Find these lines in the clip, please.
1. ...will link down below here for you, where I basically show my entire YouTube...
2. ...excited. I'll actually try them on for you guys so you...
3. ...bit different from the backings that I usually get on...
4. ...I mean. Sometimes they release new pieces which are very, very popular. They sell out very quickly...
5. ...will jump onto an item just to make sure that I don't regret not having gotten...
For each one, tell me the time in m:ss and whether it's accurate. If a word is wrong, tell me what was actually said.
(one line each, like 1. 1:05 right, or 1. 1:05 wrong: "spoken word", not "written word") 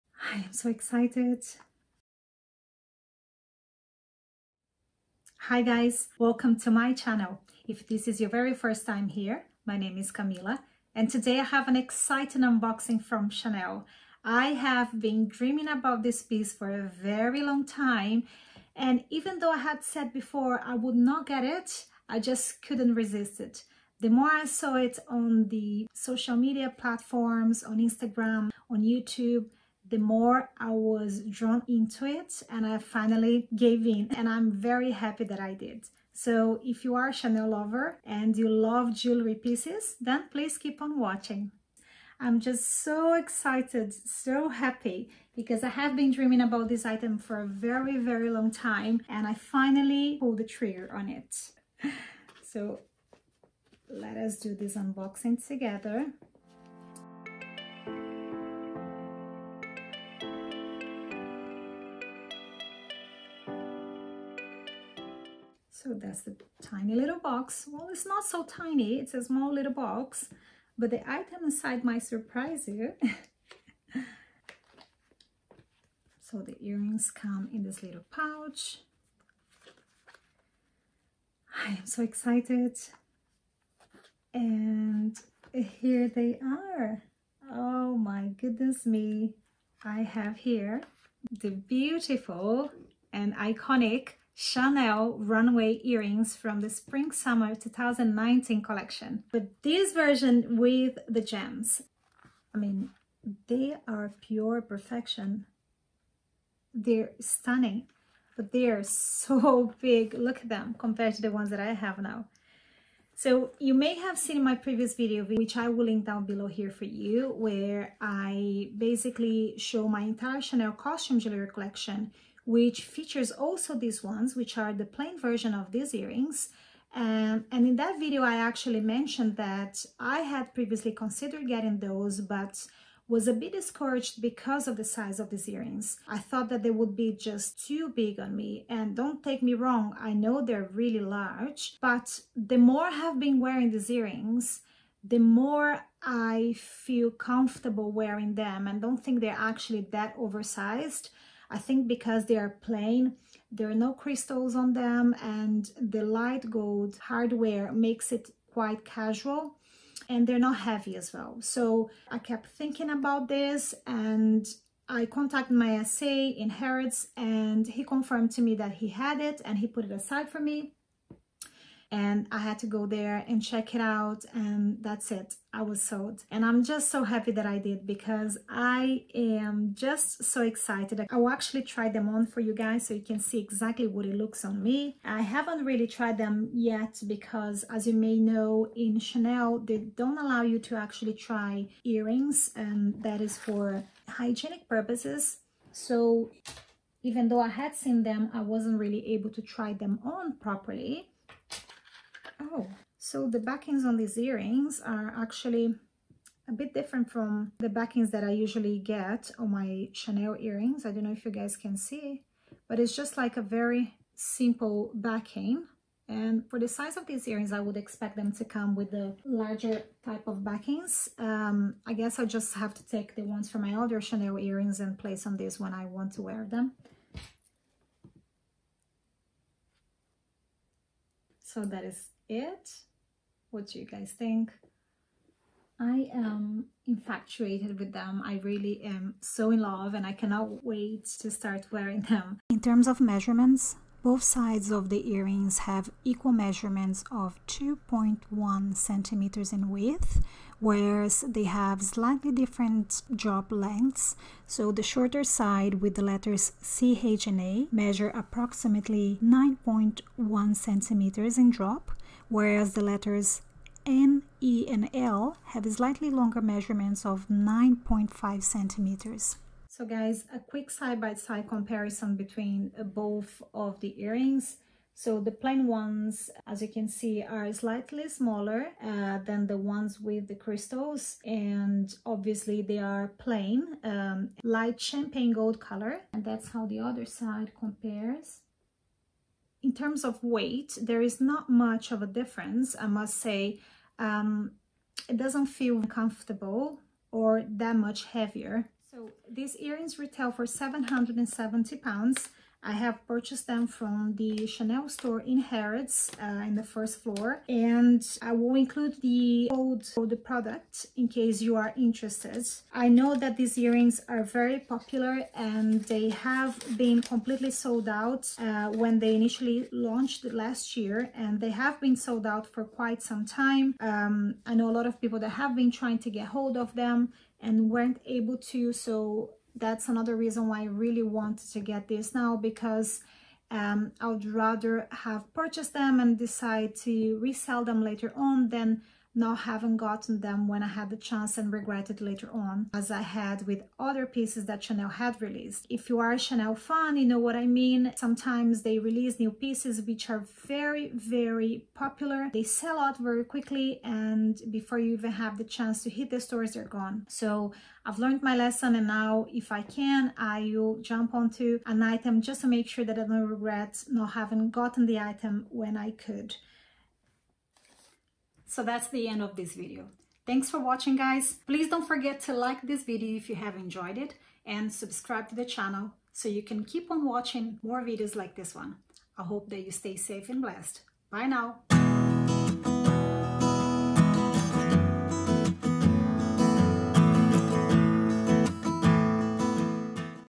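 1. 1:55 wrong: "Chanel", not "YouTube"
2. 3:00 right
3. 3:26 right
4. 5:47 right
5. 6:00 right.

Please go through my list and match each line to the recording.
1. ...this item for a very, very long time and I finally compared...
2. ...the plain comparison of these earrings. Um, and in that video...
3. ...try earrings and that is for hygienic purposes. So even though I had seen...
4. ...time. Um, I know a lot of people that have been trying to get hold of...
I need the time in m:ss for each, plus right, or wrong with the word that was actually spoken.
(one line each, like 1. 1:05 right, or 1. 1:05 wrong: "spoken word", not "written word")
1. 0:46 wrong: "pulled", not "compared"
2. 2:04 wrong: "version", not "comparison"
3. 3:11 right
4. 5:23 right.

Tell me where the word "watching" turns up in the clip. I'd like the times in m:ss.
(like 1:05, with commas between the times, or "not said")
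0:40, 6:10, 6:17.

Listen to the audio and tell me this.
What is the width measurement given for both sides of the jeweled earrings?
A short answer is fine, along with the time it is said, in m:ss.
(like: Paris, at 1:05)
2.1 centimeters, at 4:07.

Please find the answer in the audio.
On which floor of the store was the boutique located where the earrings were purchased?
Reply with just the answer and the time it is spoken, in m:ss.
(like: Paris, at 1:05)
first floor, at 5:06.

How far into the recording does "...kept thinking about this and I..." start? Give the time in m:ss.
2:42.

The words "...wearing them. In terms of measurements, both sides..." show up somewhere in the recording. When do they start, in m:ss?
4:01.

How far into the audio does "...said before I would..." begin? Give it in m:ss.
0:19.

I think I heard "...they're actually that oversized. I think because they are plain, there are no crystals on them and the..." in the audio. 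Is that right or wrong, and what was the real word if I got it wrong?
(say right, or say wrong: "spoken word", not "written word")
right.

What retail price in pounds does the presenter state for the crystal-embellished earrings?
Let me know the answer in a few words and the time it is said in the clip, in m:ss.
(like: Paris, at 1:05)
£770, at 5:00.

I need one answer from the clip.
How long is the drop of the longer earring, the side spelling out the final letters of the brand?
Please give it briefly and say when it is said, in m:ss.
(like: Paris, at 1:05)
9.5 centimeters, at 4:27.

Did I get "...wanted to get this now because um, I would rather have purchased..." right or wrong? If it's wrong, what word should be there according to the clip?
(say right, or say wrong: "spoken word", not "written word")
right.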